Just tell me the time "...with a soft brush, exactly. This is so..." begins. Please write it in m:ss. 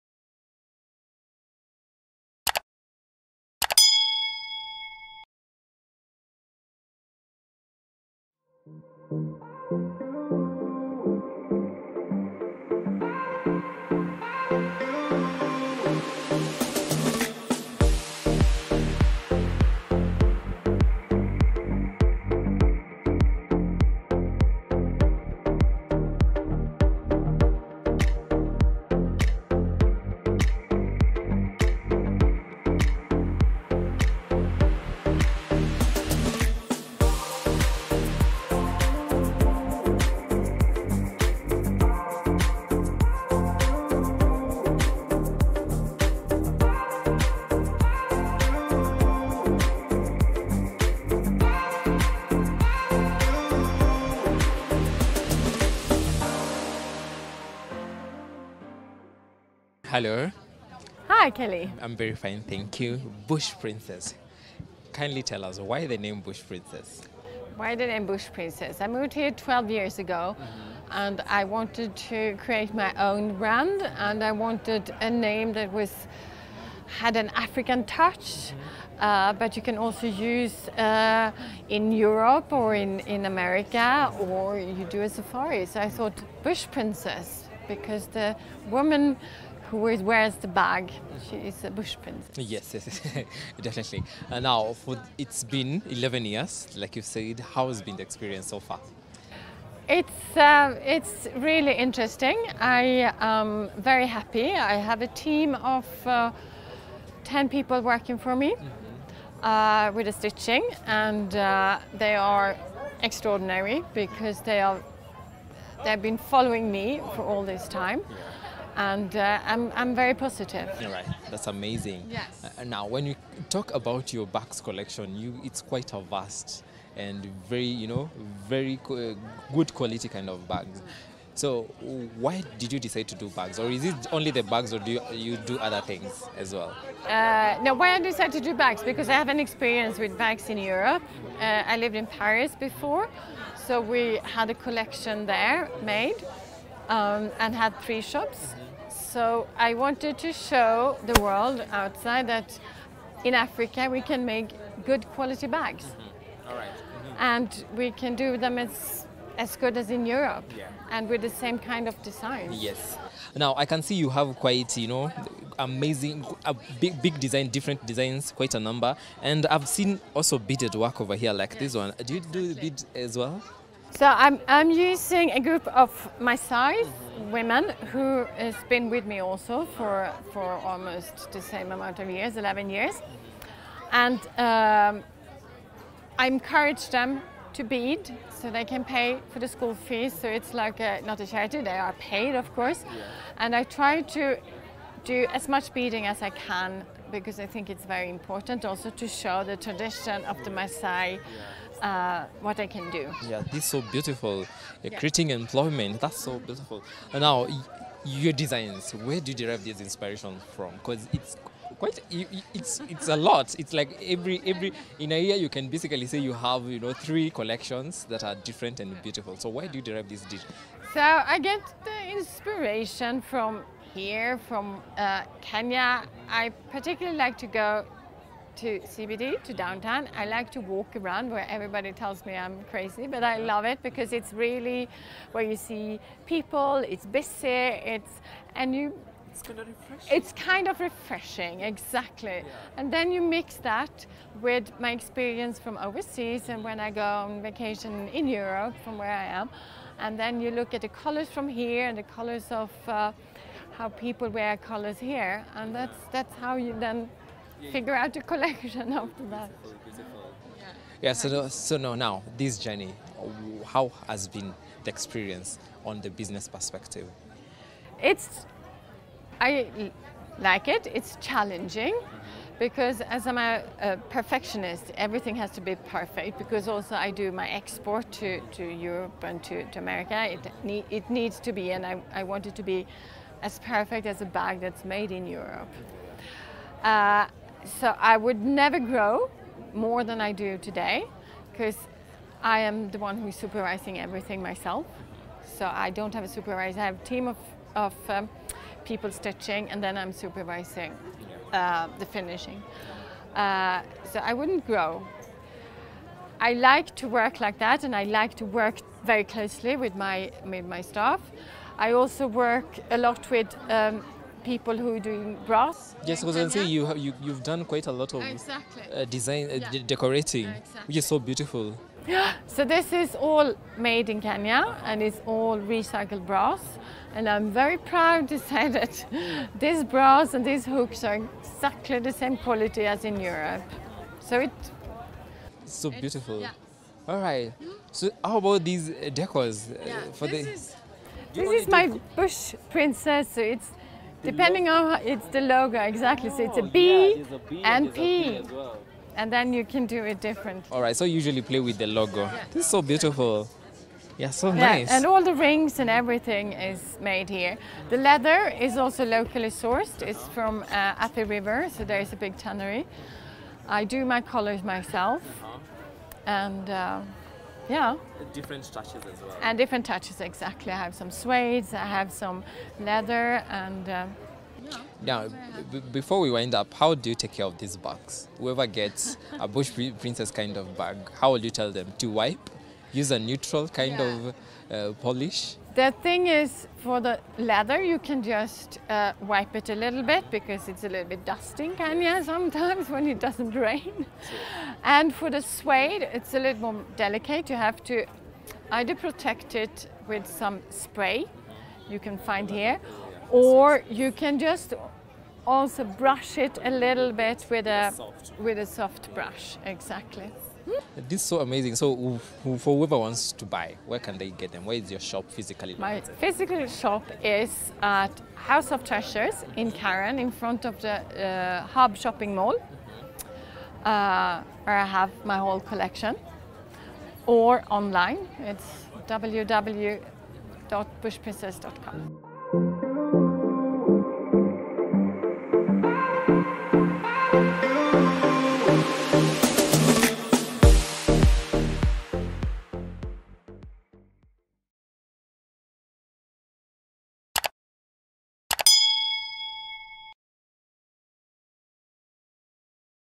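6:48.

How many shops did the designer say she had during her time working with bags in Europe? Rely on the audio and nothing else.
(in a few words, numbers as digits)
3.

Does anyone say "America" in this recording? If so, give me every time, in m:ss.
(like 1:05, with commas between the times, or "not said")
1:23, 4:39.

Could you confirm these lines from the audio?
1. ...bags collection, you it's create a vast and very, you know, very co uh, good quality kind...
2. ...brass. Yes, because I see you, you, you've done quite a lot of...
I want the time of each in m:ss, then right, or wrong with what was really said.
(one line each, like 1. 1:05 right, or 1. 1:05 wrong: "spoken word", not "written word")
1. 2:04 wrong: "quite", not "create"
2. 5:15 right.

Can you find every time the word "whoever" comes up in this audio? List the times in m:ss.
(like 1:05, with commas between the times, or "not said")
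6:18, 6:52.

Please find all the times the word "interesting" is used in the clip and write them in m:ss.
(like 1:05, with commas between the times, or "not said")
1:41.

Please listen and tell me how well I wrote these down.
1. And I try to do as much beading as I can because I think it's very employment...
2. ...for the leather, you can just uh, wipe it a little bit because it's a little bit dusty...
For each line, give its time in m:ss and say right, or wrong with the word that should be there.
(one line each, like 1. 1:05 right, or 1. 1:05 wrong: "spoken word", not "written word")
1. 3:13 wrong: "important", not "employment"
2. 6:26 right.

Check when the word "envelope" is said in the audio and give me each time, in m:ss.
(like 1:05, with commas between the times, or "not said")
not said.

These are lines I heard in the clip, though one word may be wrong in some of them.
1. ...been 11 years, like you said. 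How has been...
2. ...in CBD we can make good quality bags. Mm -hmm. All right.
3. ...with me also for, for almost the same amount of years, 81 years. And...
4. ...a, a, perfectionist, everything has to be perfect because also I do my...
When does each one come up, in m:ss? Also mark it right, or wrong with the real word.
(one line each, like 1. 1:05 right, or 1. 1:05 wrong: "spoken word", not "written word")
1. 1:35 right
2. 2:33 wrong: "Africa", not "CBD"
3. 2:58 wrong: "11", not "81"
4. 4:33 right.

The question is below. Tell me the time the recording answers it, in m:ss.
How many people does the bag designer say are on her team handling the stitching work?
1:47.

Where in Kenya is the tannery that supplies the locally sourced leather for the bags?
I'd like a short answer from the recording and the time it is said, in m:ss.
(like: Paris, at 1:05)
Athi River, at 6:00.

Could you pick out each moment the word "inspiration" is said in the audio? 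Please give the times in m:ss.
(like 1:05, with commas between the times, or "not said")
3:29, 3:42.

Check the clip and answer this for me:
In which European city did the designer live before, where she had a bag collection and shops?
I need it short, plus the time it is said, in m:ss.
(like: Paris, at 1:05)
Paris, at 2:22.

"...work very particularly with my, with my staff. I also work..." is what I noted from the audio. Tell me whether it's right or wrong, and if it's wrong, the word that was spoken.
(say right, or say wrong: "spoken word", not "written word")
wrong: "closely", not "particularly".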